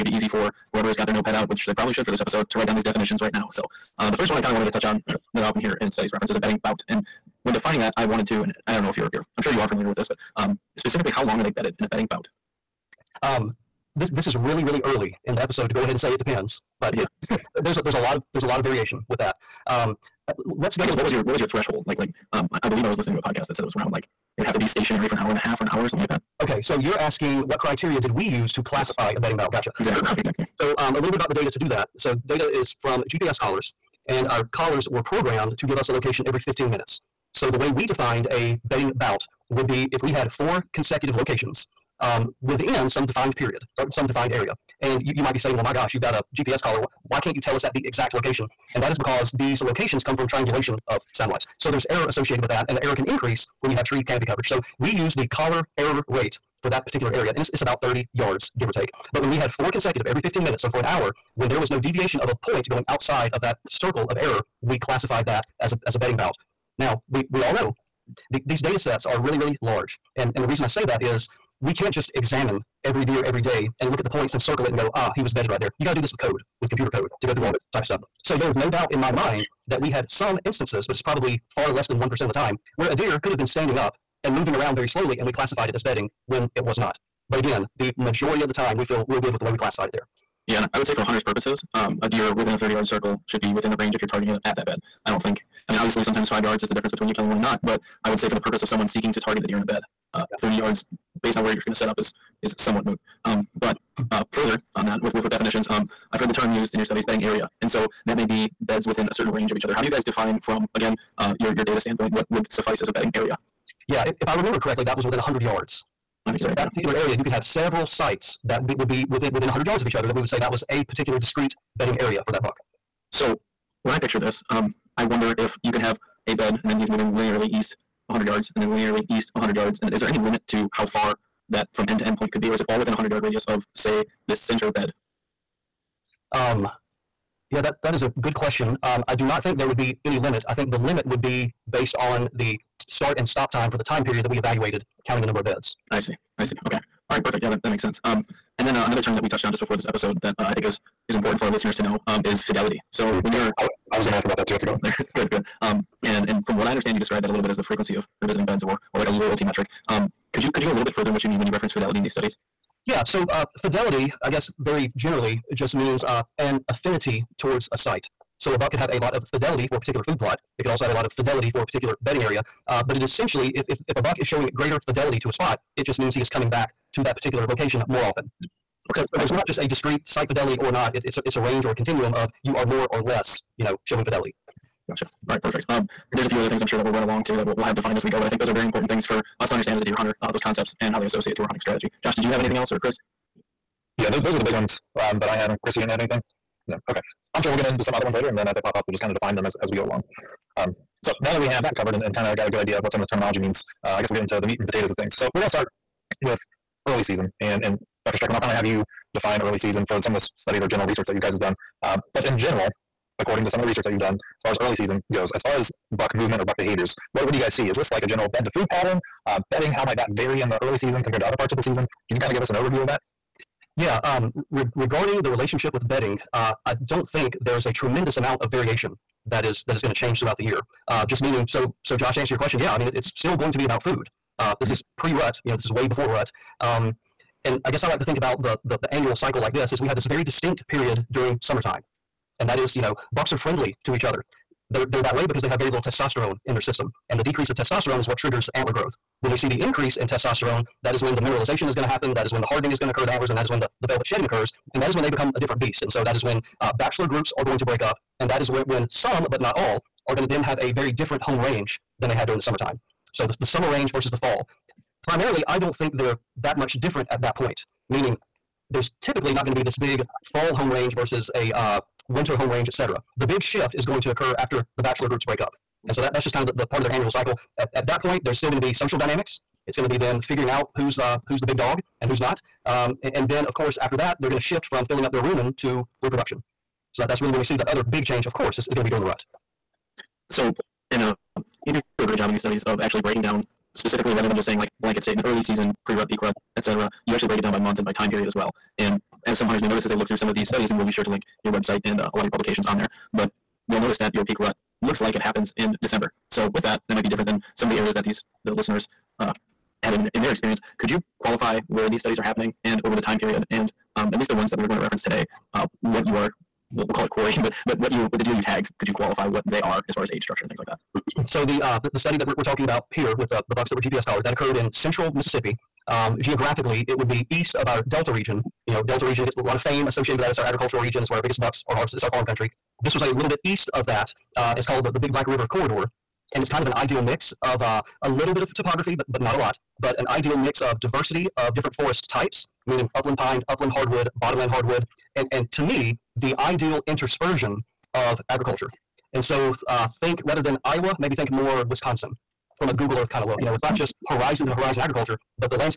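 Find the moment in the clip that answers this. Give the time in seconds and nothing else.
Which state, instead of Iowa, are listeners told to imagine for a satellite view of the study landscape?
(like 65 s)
351 s.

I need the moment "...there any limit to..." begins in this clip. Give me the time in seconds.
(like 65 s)
130 s.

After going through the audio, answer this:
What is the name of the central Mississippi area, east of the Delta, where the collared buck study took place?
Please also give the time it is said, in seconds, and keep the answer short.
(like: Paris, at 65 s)
Big Black River Corridor, at 334 s.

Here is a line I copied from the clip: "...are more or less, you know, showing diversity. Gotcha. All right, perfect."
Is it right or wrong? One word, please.
wrong.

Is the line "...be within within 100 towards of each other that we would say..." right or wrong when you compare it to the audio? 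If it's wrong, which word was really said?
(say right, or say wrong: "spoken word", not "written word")
wrong: "yards", not "towards".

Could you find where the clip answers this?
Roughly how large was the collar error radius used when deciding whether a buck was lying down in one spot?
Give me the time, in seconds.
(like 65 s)
57 s.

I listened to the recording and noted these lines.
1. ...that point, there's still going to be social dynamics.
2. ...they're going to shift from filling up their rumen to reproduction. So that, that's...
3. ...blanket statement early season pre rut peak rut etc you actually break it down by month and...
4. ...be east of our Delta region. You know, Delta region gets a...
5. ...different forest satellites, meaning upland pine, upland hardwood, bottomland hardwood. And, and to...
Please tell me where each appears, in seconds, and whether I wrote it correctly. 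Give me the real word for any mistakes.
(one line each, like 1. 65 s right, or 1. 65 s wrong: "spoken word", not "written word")
1. 277 s right
2. 284 s right
3. 294 s right
4. 327 s right
5. 341 s wrong: "types", not "satellites".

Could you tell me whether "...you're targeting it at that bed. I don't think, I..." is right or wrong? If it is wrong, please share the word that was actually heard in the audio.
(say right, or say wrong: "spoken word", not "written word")
right.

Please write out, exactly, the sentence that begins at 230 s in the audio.
Uh, just meaning, so so Josh, to answer your question, yeah, I mean it, it's still going to be about food.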